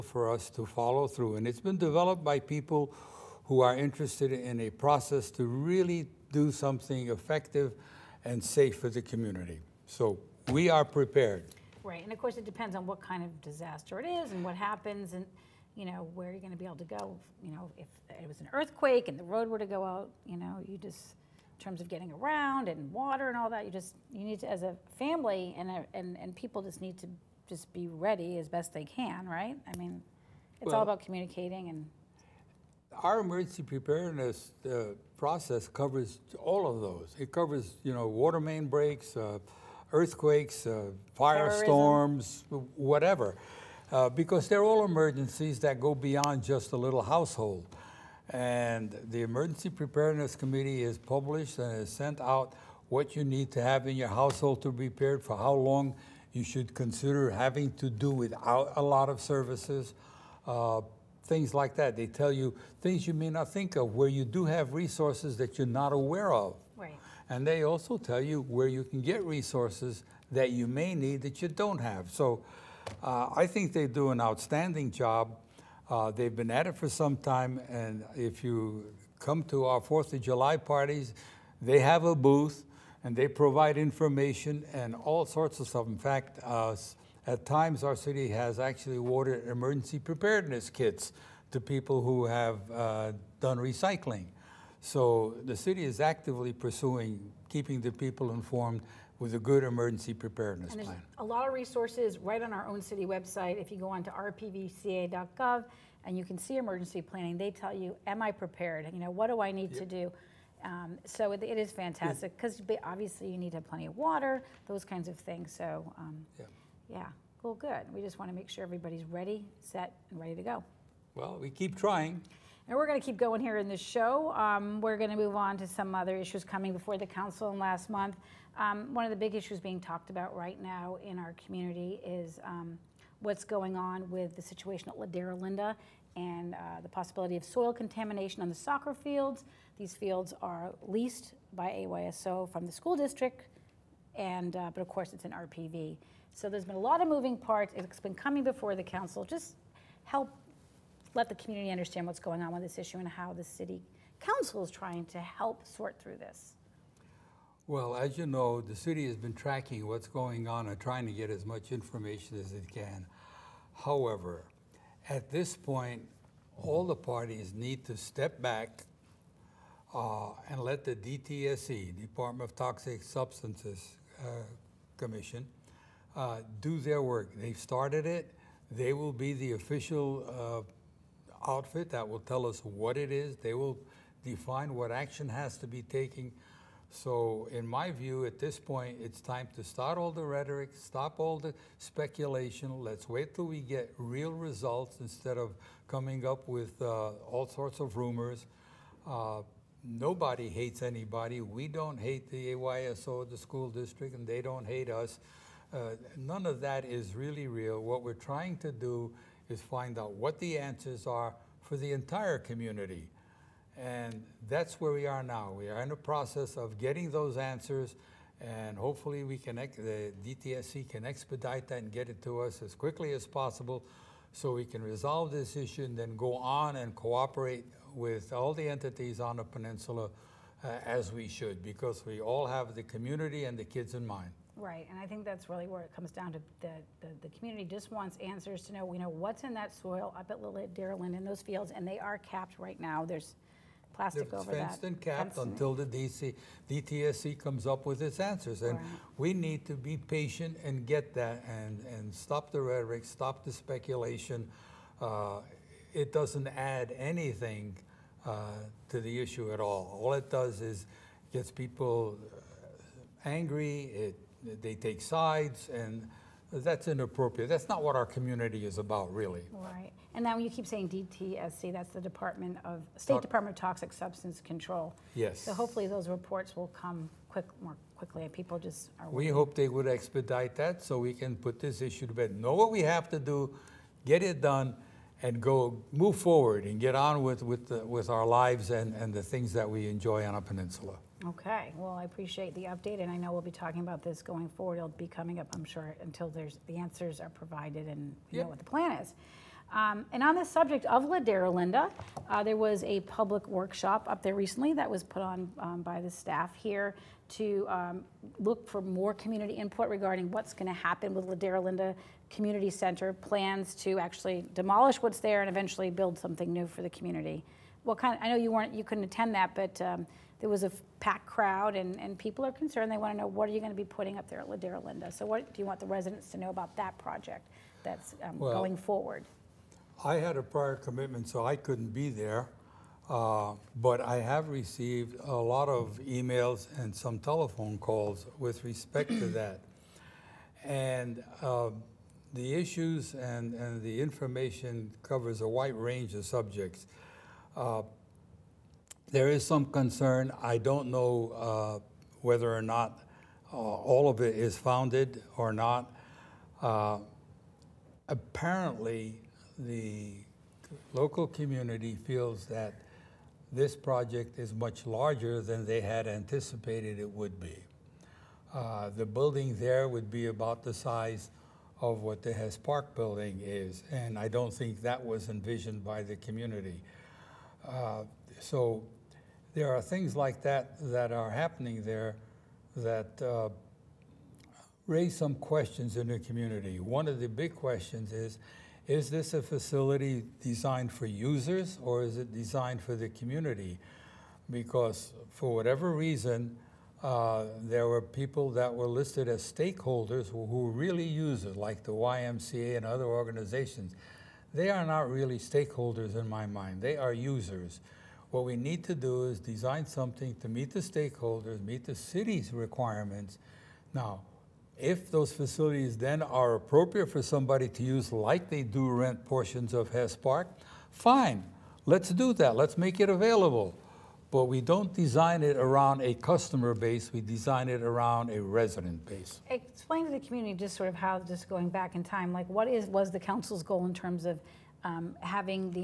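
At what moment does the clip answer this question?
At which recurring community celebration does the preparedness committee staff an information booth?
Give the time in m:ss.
1:19.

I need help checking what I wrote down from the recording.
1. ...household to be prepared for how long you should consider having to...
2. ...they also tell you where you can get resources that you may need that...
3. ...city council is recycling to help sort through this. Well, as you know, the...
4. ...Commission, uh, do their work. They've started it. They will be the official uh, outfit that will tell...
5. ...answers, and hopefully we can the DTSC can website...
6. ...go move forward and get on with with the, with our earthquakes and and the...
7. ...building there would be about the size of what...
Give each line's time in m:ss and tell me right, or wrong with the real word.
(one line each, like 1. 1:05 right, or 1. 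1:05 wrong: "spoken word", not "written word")
1. 0:54 right
2. 1:07 right
3. 2:33 wrong: "trying", not "recycling"
4. 2:54 right
5. 3:37 wrong: "expedite", not "website"
6. 4:45 wrong: "lives", not "earthquakes"
7. 6:09 right.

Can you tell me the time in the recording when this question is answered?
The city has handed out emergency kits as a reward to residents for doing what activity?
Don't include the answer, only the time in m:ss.
1:33.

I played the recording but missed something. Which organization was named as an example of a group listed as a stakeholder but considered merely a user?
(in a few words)
YMCA.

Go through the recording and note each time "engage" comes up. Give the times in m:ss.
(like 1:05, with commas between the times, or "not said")
not said.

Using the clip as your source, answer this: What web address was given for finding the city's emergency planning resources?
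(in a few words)
rpvca.gov.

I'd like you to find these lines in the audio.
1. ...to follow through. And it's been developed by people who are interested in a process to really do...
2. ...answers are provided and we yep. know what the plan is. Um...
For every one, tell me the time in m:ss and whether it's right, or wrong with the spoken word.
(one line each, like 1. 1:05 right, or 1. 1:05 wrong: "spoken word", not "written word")
1. 0:00 right
2. 4:56 right.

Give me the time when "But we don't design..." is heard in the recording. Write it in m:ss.
7:04.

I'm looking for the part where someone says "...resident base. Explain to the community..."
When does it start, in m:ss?
7:08.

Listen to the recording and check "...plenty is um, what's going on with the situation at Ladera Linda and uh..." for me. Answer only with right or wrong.
wrong.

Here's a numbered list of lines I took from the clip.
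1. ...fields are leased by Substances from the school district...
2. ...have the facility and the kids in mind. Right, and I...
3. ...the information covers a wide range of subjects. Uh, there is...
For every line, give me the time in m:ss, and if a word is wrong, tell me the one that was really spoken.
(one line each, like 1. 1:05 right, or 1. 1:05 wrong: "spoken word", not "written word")
1. 2:19 wrong: "AYSO", not "Substances"
2. 3:52 wrong: "community", not "facility"
3. 5:43 right.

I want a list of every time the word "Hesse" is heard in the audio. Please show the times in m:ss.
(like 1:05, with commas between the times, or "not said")
6:12, 6:59.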